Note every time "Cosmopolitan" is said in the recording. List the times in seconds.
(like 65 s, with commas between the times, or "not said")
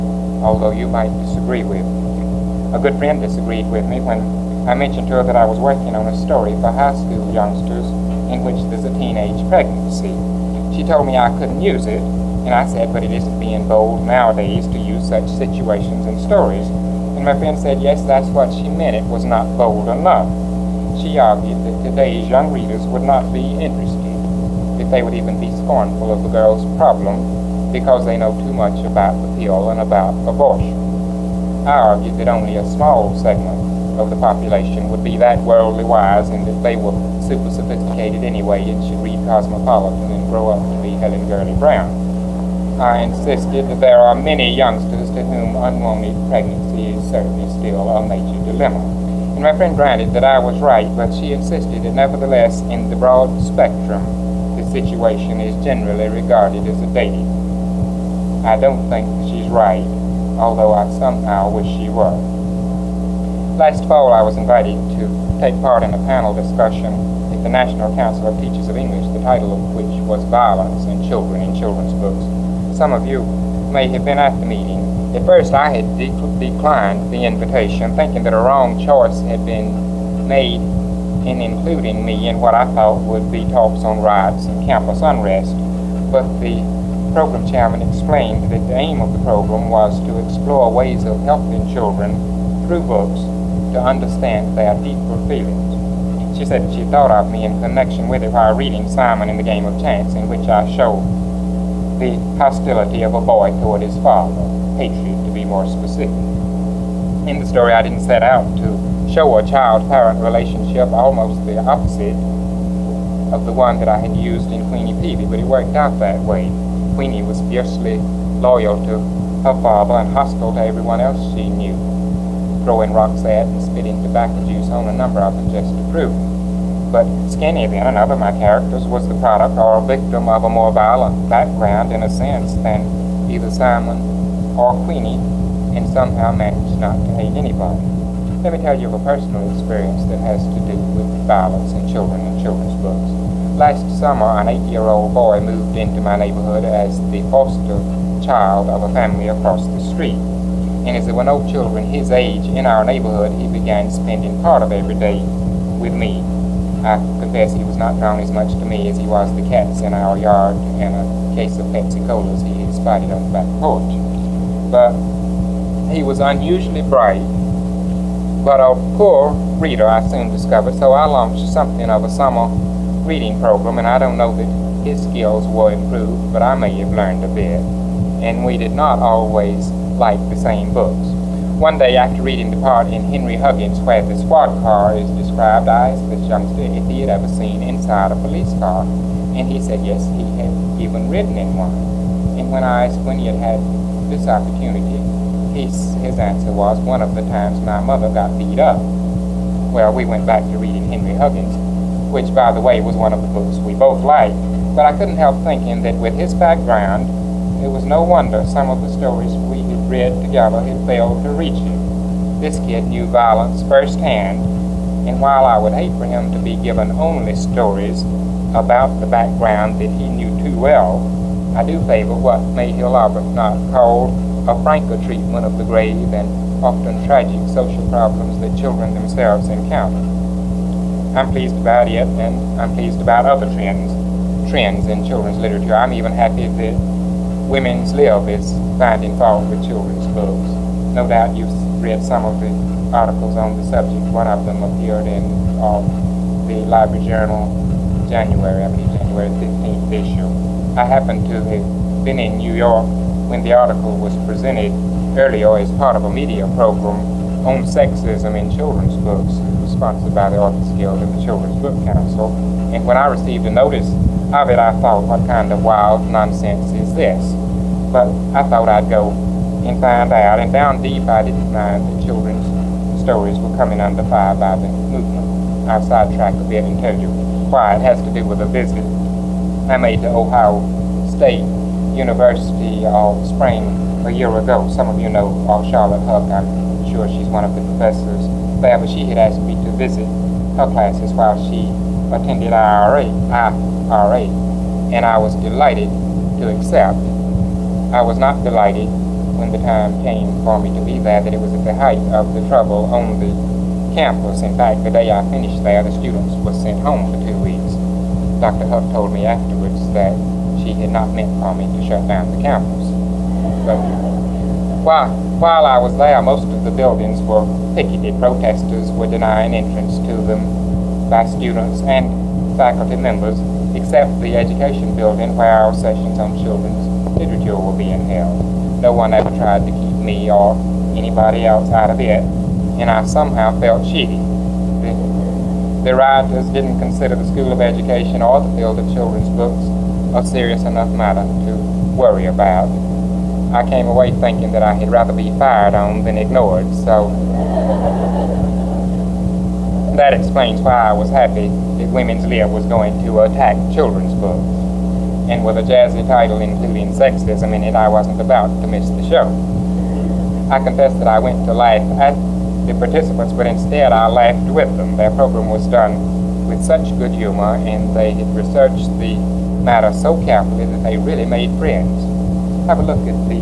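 39 s.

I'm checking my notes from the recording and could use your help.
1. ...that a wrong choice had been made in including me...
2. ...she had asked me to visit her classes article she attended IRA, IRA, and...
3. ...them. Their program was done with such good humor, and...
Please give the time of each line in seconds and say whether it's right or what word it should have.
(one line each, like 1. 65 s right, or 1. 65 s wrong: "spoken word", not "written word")
1. 78 s right
2. 288 s wrong: "while", not "article"
3. 364 s right.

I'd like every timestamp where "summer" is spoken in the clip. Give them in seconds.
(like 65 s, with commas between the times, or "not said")
143 s, 172 s.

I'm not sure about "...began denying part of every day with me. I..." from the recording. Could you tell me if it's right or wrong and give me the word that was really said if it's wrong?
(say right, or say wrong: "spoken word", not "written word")
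wrong: "spending", not "denying".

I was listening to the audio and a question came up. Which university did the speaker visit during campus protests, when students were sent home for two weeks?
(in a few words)
Ohio State University.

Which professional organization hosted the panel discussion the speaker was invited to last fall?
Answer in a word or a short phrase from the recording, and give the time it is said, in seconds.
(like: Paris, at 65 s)
National Council of Teachers of English, at 67 s.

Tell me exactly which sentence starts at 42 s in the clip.
I insisted that there are many youngsters to whom unwanted pregnancy is certainly still a major dilemma.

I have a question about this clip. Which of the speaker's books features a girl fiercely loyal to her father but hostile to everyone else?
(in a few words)
Queenie Peavy.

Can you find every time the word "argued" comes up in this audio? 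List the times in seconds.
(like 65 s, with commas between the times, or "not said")
21 s, 31 s.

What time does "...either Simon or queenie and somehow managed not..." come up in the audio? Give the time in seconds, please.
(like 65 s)
133 s.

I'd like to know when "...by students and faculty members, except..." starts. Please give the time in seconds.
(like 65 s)
321 s.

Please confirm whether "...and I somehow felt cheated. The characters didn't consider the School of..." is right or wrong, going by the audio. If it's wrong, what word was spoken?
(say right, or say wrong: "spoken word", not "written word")
wrong: "writers", not "characters".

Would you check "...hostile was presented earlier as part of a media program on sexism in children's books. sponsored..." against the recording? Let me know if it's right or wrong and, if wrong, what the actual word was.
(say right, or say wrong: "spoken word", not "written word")
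wrong: "article", not "hostile".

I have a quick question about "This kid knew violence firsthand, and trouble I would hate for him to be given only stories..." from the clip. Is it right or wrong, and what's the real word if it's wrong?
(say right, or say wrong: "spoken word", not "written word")
wrong: "while", not "trouble".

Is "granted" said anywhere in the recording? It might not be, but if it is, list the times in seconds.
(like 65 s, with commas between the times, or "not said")
49 s.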